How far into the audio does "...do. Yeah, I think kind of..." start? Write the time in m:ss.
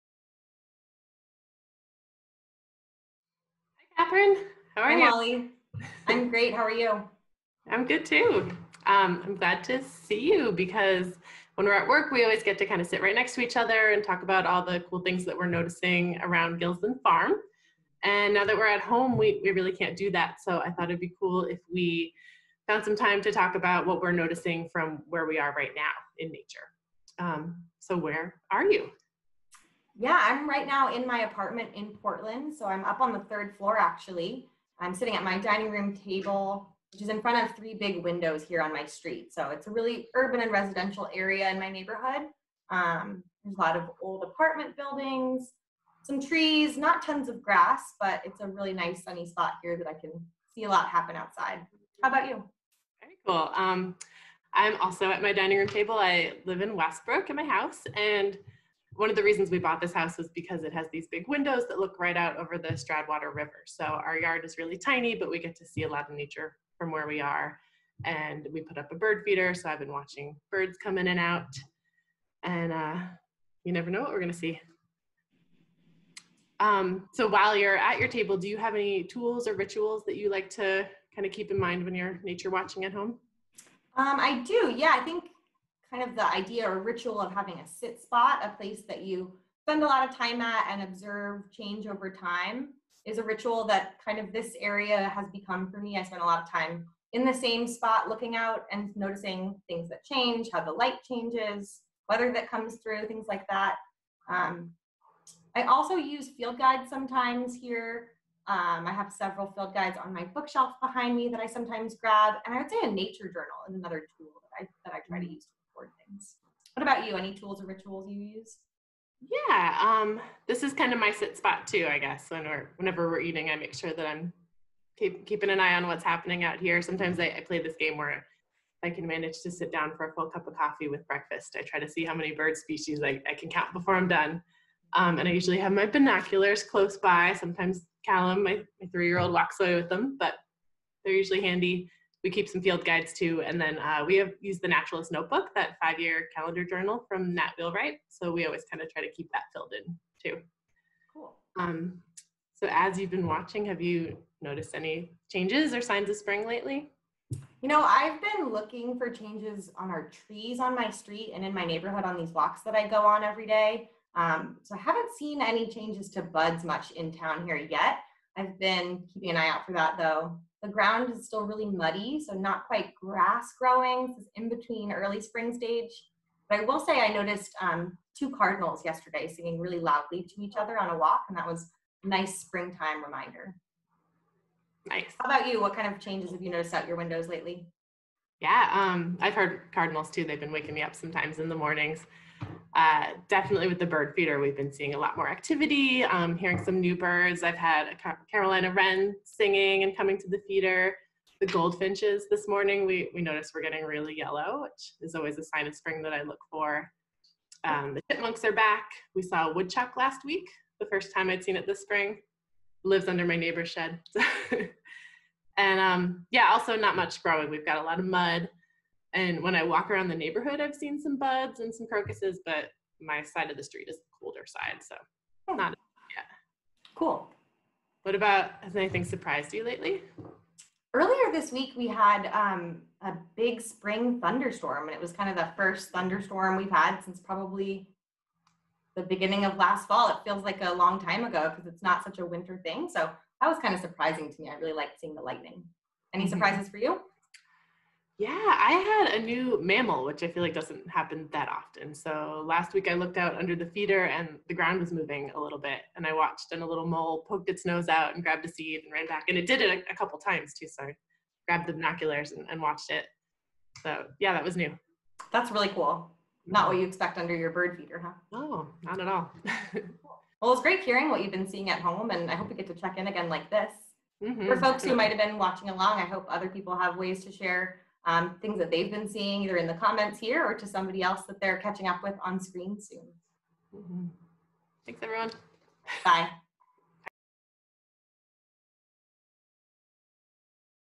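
1:24.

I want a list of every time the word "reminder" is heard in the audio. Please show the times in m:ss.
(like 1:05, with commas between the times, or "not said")
3:03.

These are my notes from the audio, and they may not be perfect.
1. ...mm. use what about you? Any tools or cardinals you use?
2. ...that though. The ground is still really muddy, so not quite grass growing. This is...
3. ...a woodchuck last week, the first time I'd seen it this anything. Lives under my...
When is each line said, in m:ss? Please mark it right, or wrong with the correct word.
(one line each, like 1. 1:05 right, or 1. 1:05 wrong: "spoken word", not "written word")
1. 1:55 wrong: "rituals", not "cardinals"
2. 2:49 right
3. 3:29 wrong: "spring", not "anything".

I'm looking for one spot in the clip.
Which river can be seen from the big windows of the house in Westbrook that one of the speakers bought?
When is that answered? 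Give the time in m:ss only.
1:02.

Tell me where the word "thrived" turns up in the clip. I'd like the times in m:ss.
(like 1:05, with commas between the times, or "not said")
not said.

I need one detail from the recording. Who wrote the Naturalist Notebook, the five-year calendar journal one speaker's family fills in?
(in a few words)
Nat Wheelwright.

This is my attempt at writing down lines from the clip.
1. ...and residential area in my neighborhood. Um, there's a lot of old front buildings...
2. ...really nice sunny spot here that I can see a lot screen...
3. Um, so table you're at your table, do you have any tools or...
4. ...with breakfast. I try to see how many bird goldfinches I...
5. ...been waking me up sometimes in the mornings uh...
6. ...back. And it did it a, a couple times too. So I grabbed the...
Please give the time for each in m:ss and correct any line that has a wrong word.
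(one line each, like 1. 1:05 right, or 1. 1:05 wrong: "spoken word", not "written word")
1. 0:40 wrong: "apartment", not "front"
2. 0:48 wrong: "happen", not "screen"
3. 1:16 wrong: "while", not "table"
4. 2:10 wrong: "species", not "goldfinches"
5. 3:10 right
6. 4:19 right.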